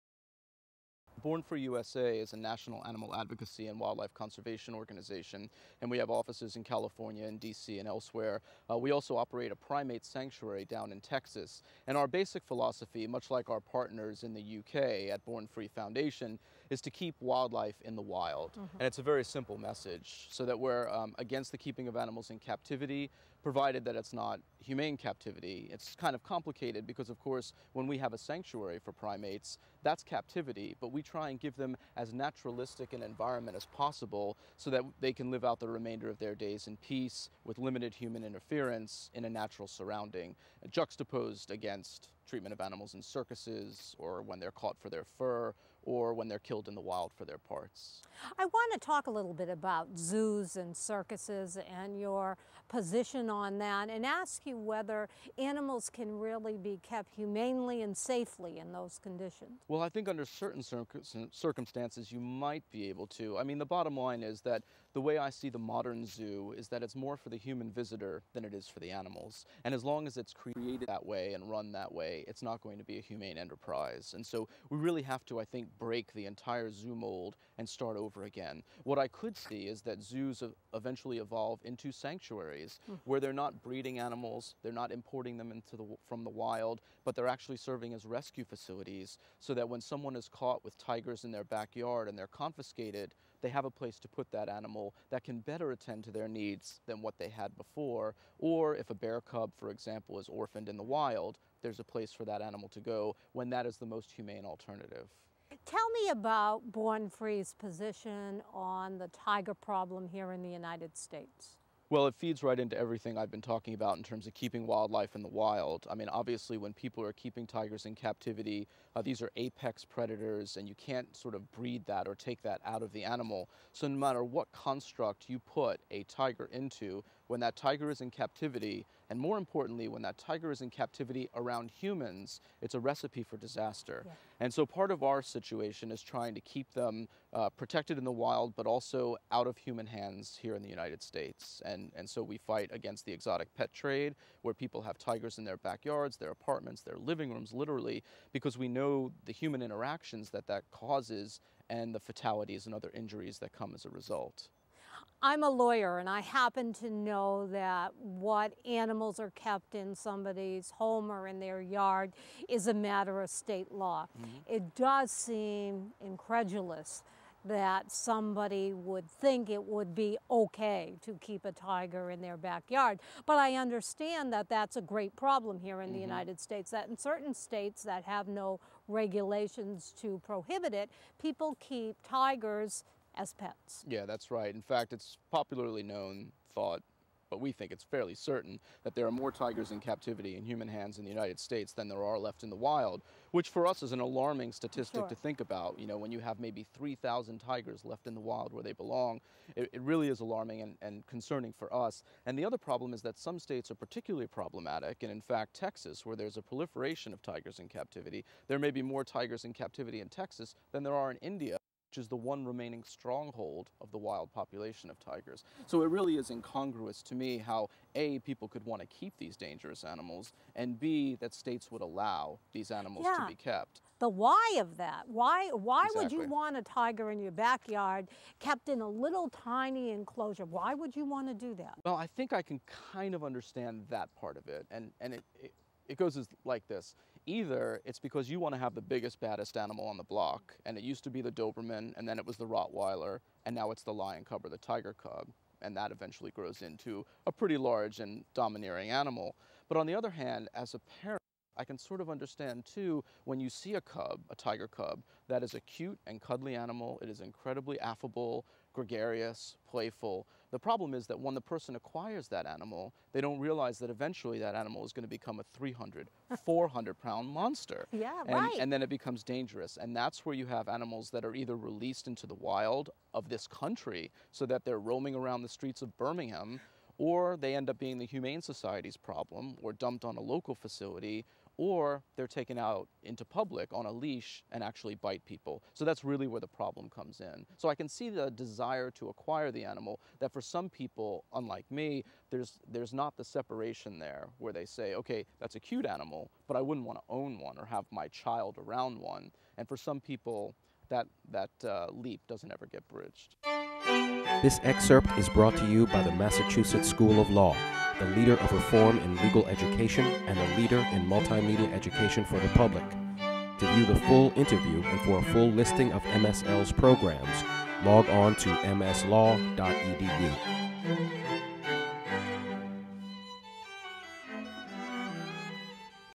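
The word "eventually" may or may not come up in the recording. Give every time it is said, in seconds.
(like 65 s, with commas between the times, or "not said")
80 s, 245 s, 263 s.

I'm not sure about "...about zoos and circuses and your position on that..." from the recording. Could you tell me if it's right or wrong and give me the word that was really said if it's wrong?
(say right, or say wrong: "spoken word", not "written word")
right.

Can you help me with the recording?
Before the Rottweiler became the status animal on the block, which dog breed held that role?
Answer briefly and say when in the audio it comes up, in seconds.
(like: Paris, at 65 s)
Doberman, at 241 s.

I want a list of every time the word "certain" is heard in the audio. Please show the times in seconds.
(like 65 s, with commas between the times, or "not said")
60 s, 176 s, 188 s.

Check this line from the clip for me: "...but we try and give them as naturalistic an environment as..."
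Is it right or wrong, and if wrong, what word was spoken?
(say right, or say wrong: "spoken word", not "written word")
right.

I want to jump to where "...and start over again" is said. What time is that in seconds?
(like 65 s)
77 s.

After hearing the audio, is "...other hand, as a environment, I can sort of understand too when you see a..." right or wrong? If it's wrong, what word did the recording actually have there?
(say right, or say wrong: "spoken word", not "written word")
wrong: "parent", not "environment".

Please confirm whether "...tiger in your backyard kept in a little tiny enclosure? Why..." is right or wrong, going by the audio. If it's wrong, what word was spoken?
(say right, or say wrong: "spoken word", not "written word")
right.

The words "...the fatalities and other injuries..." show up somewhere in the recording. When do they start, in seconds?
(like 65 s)
151 s.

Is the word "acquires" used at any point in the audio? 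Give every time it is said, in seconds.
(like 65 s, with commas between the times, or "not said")
261 s, 289 s.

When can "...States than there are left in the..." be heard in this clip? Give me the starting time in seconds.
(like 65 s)
191 s.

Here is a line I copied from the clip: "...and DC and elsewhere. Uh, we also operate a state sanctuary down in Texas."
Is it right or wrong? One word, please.
wrong.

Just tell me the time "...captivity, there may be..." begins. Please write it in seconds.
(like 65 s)
207 s.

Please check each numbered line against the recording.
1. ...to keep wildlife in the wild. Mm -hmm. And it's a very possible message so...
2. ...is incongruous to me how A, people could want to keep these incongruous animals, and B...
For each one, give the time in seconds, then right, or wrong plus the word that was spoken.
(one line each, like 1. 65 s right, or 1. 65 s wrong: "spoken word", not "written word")
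1. 16 s wrong: "simple", not "possible"
2. 216 s wrong: "dangerous", not "incongruous".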